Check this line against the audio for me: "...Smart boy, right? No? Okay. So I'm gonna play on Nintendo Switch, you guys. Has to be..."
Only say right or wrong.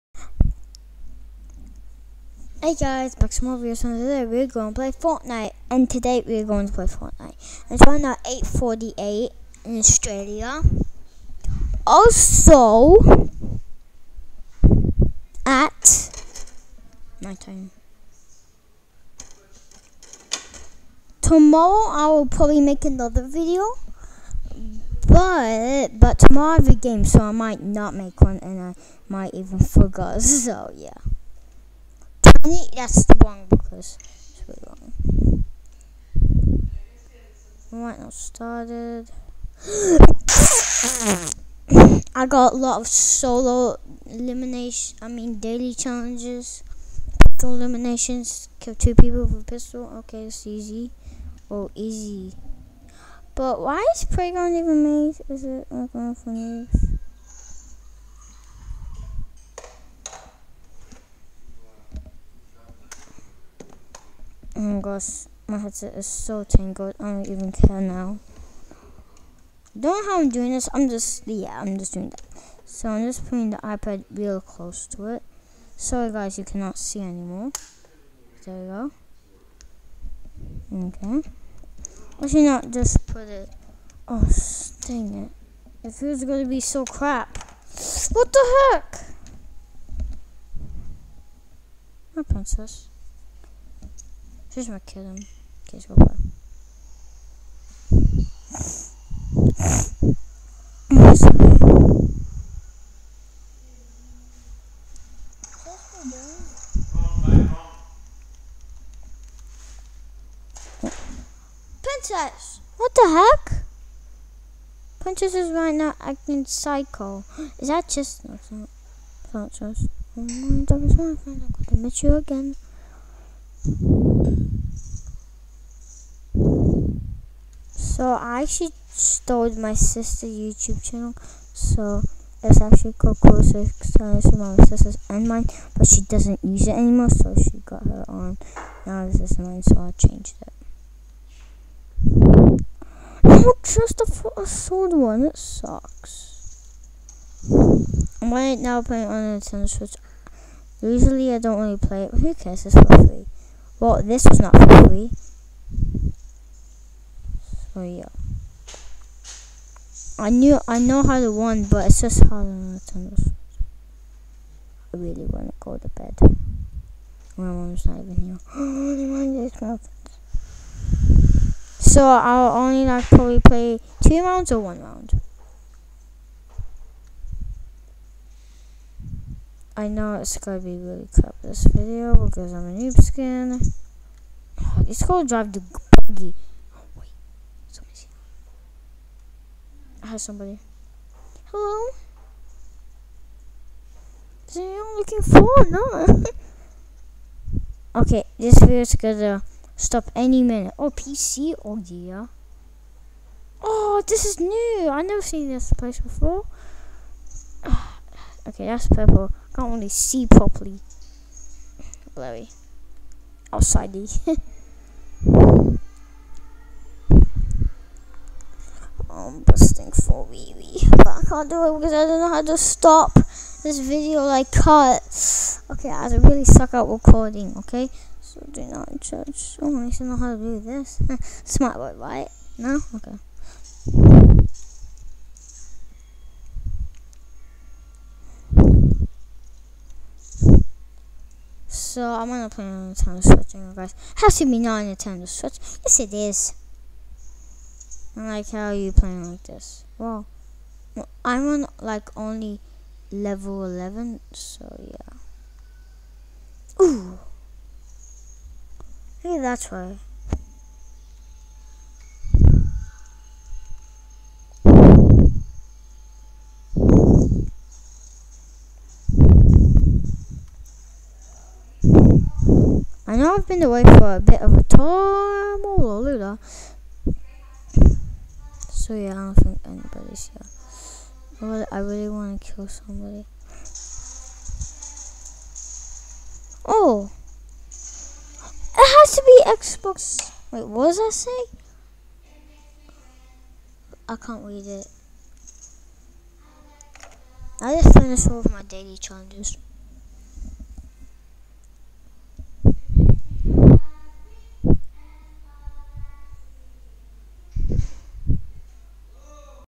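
right.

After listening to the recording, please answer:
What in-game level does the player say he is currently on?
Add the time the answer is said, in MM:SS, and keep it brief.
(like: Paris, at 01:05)
11, at 04:13.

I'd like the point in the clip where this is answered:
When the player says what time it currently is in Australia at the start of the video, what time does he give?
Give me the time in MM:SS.
00:08.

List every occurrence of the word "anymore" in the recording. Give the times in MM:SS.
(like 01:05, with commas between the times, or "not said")
01:16, 02:16.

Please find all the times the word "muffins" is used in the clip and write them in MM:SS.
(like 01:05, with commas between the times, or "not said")
02:49.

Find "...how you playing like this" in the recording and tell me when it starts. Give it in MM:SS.
04:08.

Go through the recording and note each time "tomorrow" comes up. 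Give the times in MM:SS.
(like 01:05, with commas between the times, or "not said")
00:21, 00:26.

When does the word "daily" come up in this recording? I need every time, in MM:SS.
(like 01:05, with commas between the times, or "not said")
00:45, 04:58.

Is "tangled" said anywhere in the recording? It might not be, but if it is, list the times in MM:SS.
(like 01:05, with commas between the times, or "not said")
01:06.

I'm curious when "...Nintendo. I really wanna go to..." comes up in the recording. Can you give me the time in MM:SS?
02:42.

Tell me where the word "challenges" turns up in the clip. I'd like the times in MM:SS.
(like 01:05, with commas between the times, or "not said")
00:45, 04:58.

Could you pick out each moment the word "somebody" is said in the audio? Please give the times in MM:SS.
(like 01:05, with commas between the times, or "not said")
03:10, 04:42.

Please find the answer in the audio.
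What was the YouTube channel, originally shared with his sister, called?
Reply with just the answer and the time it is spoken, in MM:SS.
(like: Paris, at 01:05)
Closer Science, at 02:13.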